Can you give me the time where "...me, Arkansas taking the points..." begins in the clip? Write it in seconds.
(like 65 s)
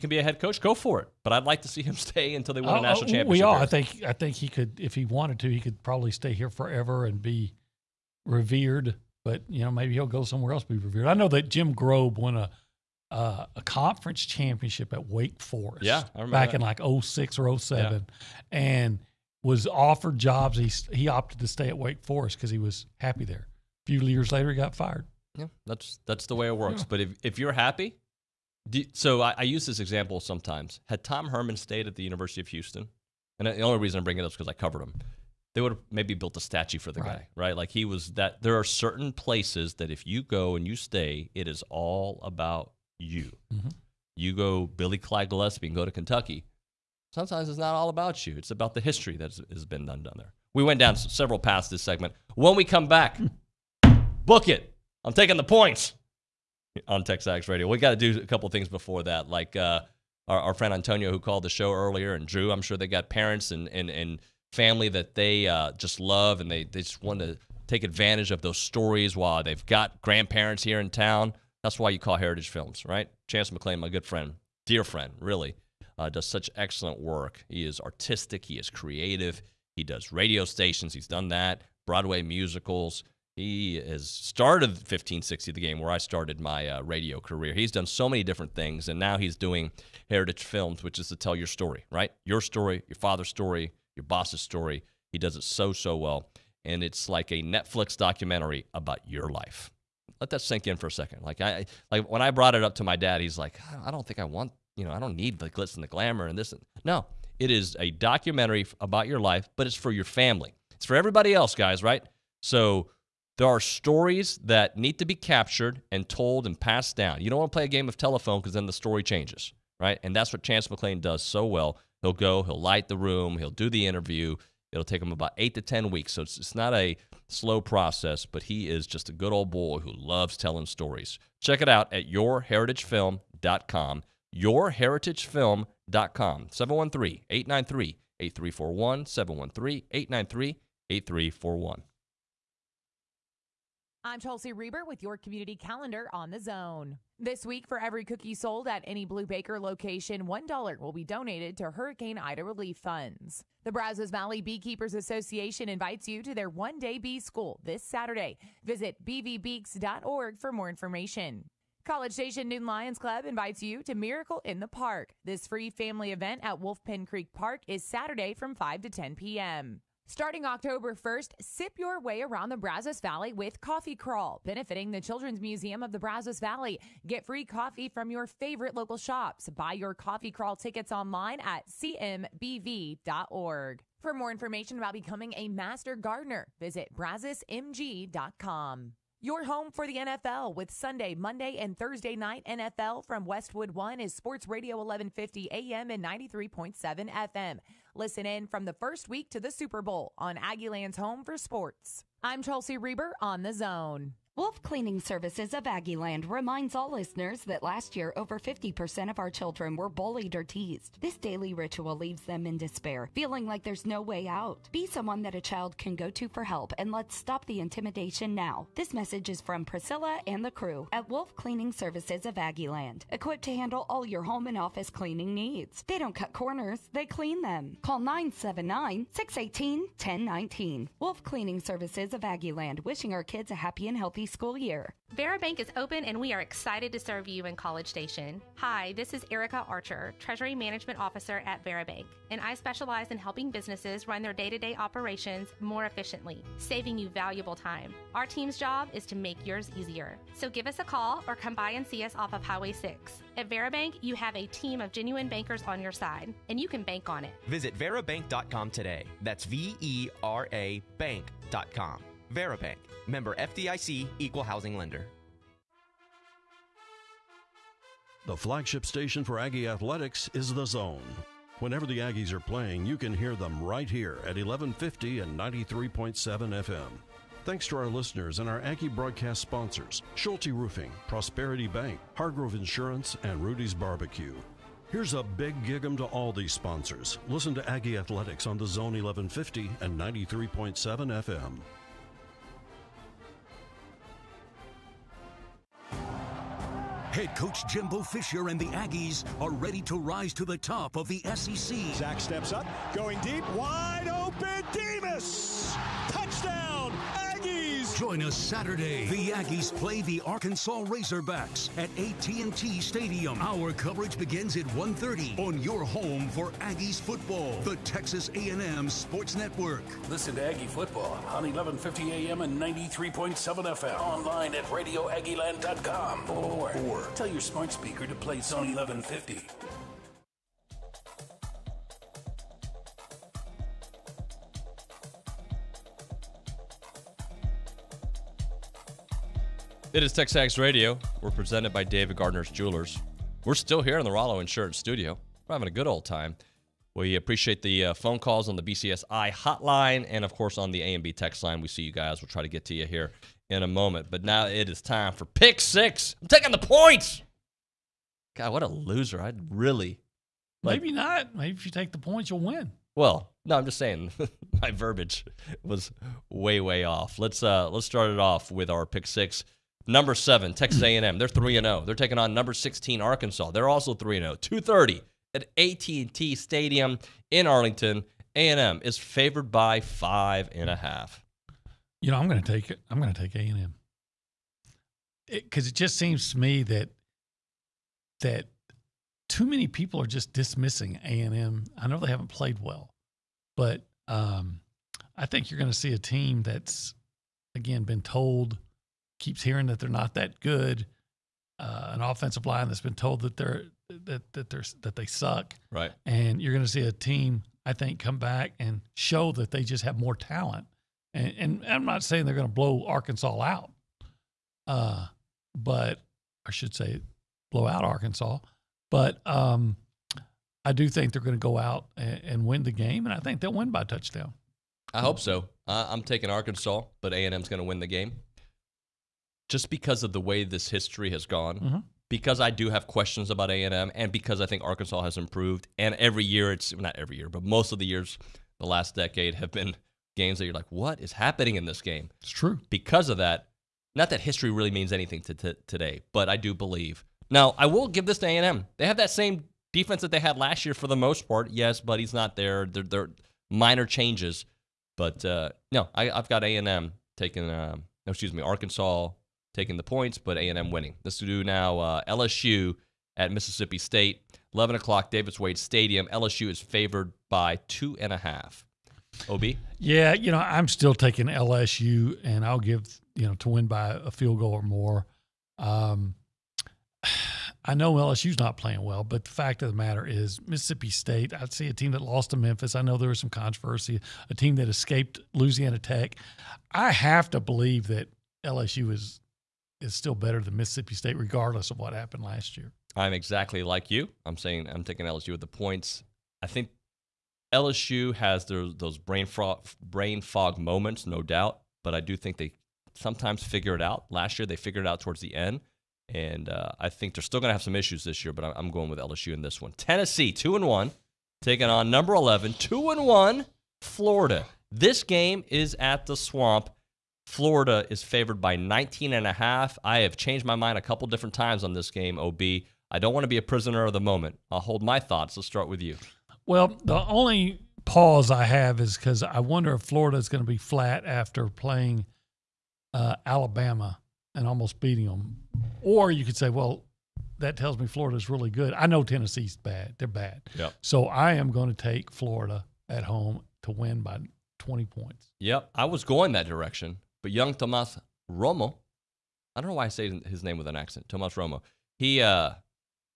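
458 s.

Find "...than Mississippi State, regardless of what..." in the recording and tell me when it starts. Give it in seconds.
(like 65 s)
490 s.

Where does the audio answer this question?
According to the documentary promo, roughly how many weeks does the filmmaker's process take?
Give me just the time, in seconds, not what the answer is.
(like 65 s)
125 s.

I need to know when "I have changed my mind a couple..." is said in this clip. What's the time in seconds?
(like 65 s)
519 s.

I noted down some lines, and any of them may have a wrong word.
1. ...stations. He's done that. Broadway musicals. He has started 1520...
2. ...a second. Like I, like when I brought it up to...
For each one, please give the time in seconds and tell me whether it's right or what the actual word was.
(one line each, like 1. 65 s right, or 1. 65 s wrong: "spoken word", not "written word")
1. 80 s wrong: "1560", not "1520"
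2. 100 s right.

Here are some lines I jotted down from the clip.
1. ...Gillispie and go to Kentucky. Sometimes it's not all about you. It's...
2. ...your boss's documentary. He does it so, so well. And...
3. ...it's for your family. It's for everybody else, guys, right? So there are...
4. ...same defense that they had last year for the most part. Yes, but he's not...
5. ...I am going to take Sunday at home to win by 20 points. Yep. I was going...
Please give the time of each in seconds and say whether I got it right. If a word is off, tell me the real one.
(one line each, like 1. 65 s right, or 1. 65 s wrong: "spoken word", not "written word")
1. 45 s right
2. 93 s wrong: "story", not "documentary"
3. 109 s right
4. 449 s right
5. 541 s wrong: "Florida", not "Sunday".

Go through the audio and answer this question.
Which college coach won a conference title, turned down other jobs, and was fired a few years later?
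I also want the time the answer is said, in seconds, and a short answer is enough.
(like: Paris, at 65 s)
Jim Grobe, at 11 s.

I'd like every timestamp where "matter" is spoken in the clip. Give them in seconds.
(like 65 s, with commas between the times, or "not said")
479 s.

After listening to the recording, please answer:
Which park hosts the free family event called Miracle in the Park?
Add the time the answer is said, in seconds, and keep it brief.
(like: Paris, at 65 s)
Wolf Pen Creek Park, at 166 s.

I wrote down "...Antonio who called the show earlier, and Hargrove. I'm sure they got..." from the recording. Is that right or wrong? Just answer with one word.
wrong.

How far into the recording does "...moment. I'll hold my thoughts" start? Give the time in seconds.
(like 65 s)
523 s.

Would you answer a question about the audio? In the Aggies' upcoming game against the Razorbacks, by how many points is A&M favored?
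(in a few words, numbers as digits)
5.5.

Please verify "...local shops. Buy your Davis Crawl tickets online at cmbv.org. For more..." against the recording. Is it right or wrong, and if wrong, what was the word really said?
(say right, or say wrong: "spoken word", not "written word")
wrong: "Coffee", not "Davis".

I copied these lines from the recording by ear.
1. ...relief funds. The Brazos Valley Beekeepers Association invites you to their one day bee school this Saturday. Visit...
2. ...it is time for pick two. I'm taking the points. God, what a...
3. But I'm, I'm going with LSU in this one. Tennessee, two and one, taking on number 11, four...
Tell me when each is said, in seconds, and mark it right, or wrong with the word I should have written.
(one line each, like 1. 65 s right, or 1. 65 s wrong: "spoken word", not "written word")
1. 152 s right
2. 354 s wrong: "six", not "two"
3. 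508 s wrong: "two", not "four".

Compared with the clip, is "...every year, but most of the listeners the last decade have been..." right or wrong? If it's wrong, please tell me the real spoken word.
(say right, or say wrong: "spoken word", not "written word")
wrong: "years", not "listeners".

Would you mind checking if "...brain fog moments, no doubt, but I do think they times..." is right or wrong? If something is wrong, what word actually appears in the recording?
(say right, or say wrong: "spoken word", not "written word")
wrong: "sometimes", not "times".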